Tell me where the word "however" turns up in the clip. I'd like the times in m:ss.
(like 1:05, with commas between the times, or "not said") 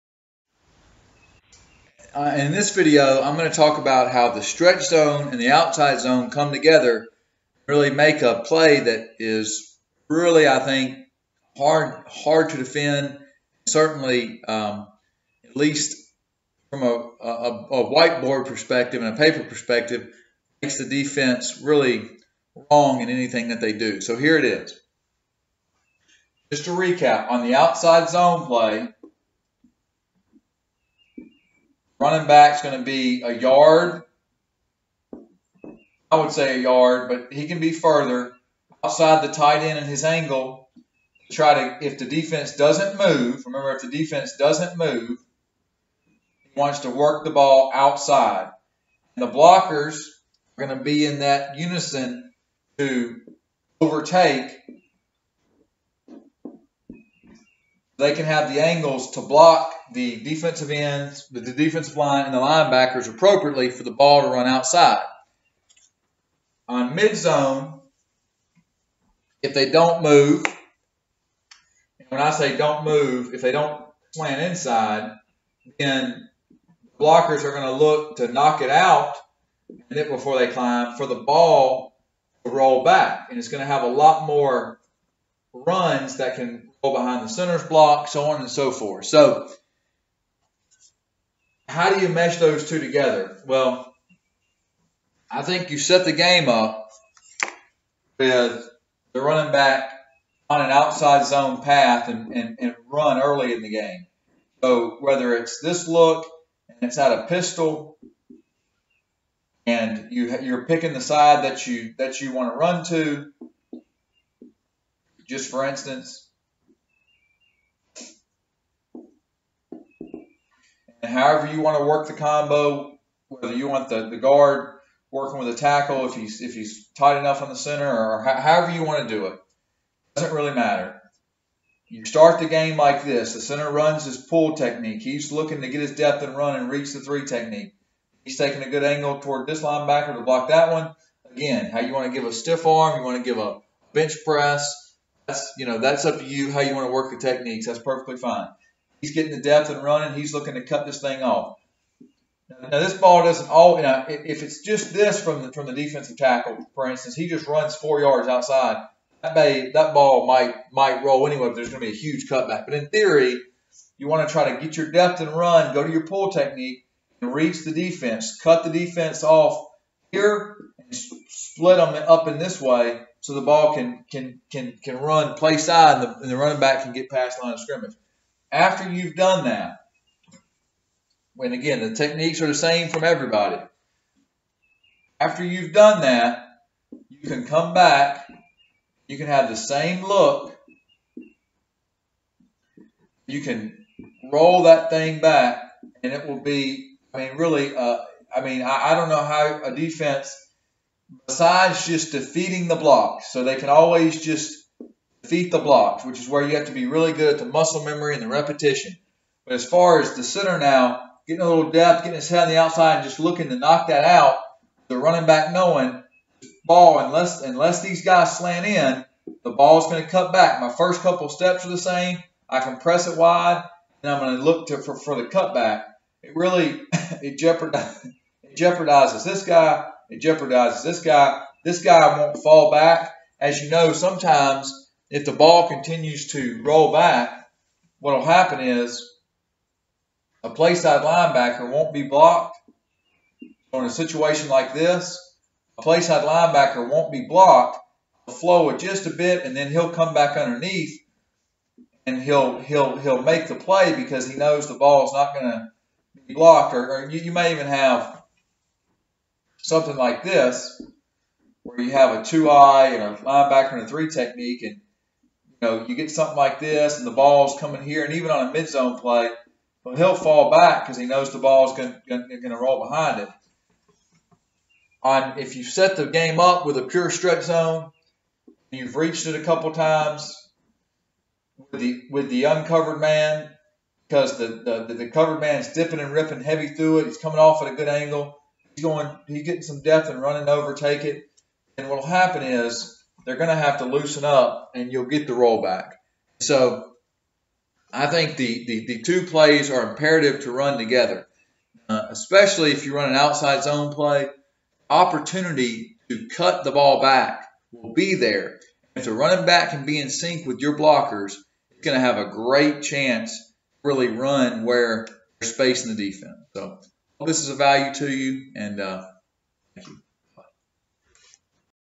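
2:01, 2:08.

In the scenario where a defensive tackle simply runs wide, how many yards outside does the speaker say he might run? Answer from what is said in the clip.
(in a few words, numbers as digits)
4.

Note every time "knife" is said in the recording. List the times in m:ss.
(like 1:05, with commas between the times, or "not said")
not said.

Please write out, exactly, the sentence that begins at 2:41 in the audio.
But there's going to be a huge cutback.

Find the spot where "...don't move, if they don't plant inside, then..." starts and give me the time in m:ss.
1:12.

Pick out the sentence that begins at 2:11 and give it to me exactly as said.
You start the game like this.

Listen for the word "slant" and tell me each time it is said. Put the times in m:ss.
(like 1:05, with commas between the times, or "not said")
3:38.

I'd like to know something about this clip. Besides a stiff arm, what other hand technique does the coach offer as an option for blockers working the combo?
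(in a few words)
bench press.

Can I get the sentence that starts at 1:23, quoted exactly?
And it's going to have a lot more runs that can behind the center's block, so on and so forth.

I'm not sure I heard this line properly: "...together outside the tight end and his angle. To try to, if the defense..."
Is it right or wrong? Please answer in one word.
wrong.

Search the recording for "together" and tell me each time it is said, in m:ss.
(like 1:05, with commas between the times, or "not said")
0:06, 1:32, 5:00.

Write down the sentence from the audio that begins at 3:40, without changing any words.
My first couple steps are the same.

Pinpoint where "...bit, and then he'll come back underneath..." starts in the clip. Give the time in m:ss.
4:09.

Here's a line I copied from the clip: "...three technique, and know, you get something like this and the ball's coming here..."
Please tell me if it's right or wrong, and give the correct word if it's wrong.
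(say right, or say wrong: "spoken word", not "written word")
right.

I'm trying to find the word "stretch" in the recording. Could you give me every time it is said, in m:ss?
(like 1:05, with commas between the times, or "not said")
0:04, 4:37.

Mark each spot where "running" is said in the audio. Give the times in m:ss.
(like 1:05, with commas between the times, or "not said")
0:32, 1:39, 2:29, 2:56, 3:34, 4:50, 5:09.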